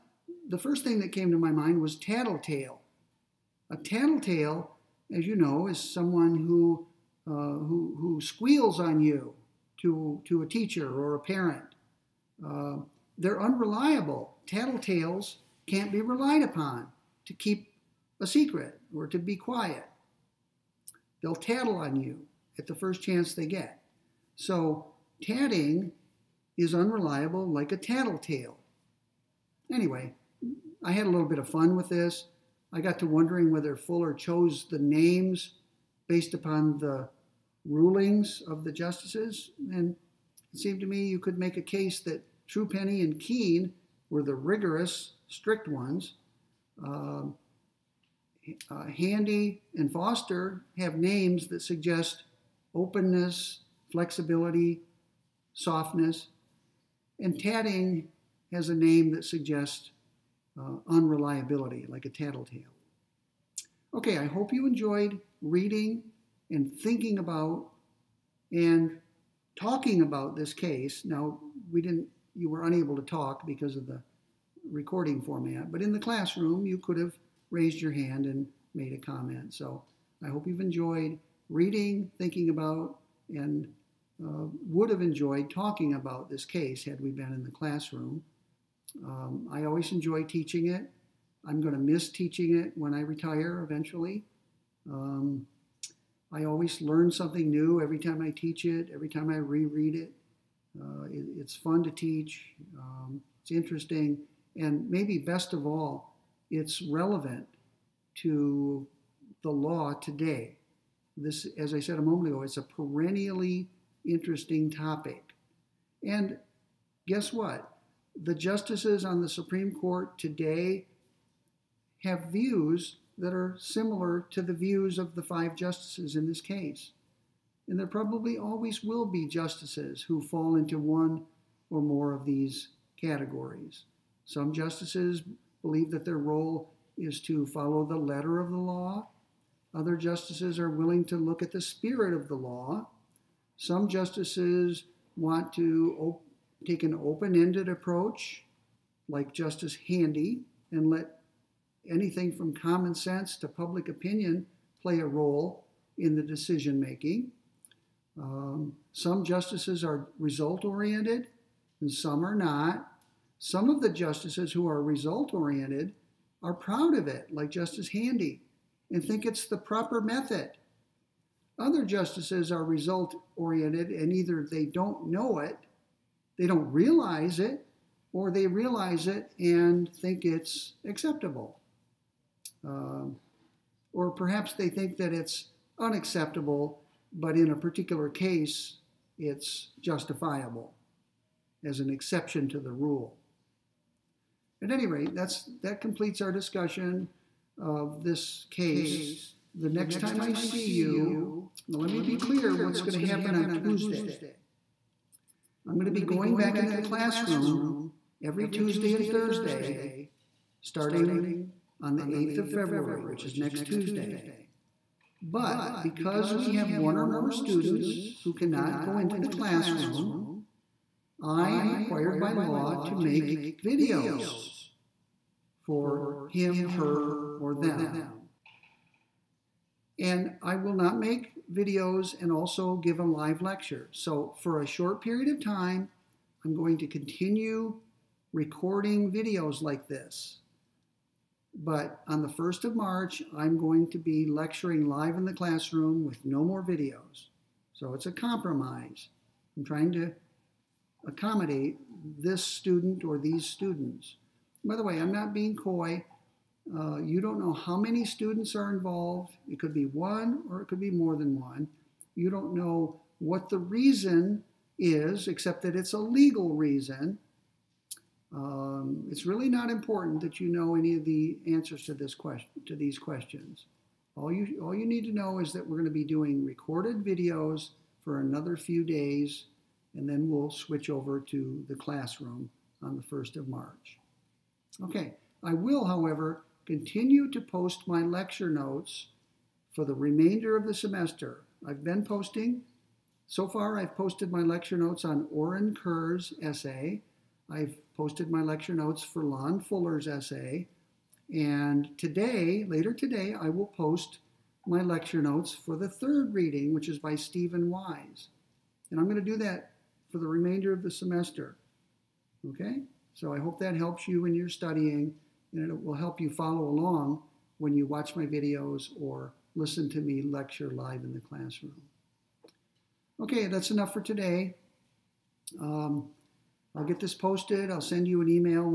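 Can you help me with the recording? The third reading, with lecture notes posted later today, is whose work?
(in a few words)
Steven Wise.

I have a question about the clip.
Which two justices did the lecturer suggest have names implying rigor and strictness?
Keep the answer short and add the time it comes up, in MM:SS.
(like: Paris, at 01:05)
Truepenny and Keen, at 00:42.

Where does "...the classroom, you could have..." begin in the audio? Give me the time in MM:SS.
01:15.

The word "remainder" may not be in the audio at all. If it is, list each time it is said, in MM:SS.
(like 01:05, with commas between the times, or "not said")
04:49, 05:10.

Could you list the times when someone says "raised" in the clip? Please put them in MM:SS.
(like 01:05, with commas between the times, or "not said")
01:17.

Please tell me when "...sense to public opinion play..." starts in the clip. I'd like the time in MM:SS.
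02:32.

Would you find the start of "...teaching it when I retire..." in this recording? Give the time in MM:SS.
01:32.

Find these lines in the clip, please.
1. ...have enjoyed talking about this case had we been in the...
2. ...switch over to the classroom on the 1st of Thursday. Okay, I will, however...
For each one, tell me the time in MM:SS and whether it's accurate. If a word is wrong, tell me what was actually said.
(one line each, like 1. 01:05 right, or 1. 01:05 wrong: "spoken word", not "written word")
1. 01:24 right
2. 04:40 wrong: "March", not "Thursday".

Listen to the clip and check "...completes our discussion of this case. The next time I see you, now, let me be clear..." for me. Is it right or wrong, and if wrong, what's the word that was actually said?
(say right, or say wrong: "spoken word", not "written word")
right.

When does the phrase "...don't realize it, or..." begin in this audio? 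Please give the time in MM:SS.
02:56.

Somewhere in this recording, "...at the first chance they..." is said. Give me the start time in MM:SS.
00:22.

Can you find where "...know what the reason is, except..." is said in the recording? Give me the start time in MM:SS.
04:22.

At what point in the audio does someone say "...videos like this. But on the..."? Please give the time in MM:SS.
03:59.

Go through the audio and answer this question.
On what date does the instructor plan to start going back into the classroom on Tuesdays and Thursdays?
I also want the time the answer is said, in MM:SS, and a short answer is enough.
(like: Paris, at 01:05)
February 8, at 03:32.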